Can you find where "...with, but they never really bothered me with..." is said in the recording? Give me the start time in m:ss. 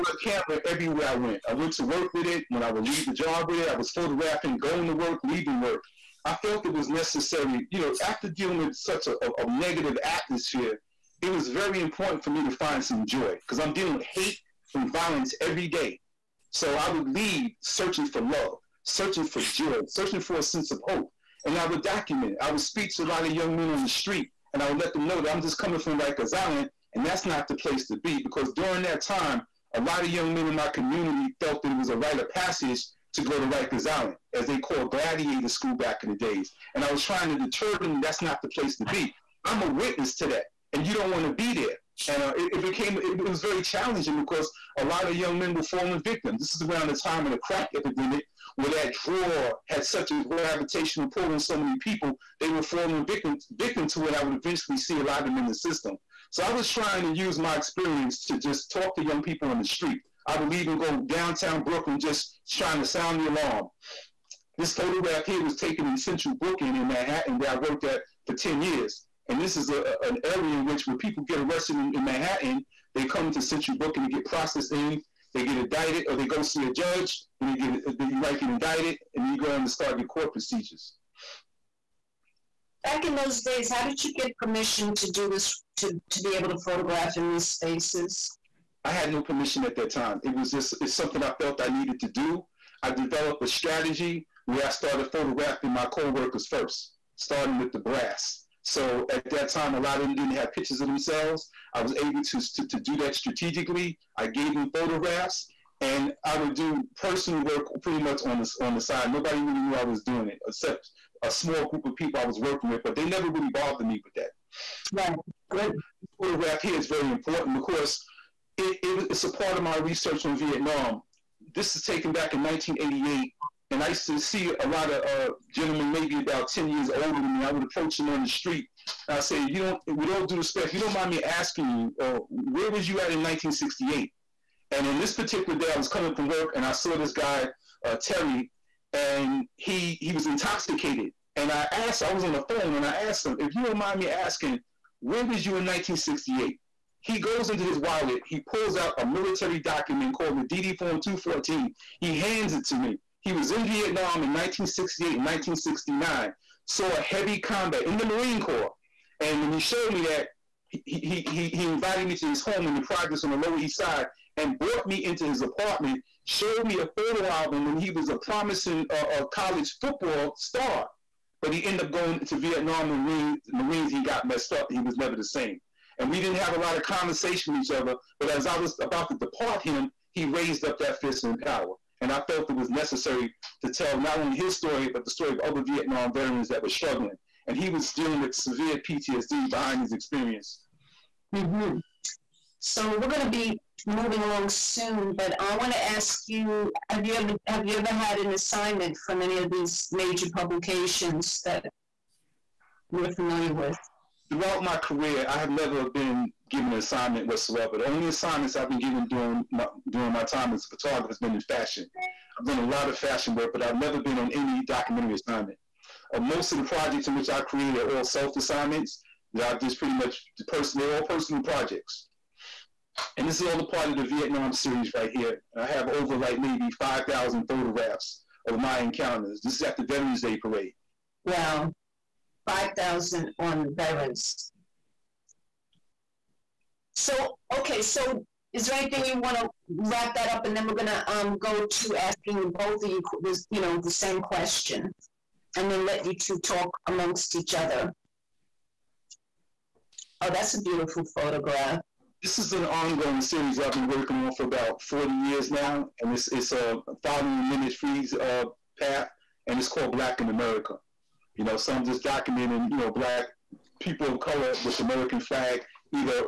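1:52.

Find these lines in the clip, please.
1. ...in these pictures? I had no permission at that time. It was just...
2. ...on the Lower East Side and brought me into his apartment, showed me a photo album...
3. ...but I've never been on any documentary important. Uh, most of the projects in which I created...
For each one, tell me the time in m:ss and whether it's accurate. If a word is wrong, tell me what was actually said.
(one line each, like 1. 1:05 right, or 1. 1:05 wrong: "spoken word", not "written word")
1. 1:27 wrong: "spaces", not "pictures"
2. 2:43 right
3. 3:33 wrong: "assignment", not "important".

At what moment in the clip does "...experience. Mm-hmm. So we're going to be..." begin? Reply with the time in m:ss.
3:09.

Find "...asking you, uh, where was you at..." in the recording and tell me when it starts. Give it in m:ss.
2:11.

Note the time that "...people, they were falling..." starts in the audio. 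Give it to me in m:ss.
0:51.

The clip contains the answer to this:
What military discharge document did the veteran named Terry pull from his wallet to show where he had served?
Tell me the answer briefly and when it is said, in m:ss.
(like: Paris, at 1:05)
DD Form 214, at 2:30.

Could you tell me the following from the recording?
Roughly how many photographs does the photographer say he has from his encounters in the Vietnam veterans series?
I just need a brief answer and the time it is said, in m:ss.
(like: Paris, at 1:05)
5,000, at 3:46.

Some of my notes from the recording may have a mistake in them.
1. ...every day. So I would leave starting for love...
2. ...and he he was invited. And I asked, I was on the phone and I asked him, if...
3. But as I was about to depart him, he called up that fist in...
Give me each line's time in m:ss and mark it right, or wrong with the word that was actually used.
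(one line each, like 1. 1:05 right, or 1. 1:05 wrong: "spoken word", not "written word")
1. 0:15 wrong: "searching", not "starting"
2. 2:18 wrong: "intoxicated", not "invited"
3. 2:58 wrong: "raised", not "called".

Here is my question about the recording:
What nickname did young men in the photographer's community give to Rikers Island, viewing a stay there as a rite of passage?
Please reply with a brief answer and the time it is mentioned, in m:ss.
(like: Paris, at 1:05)
gladiator school, at 0:34.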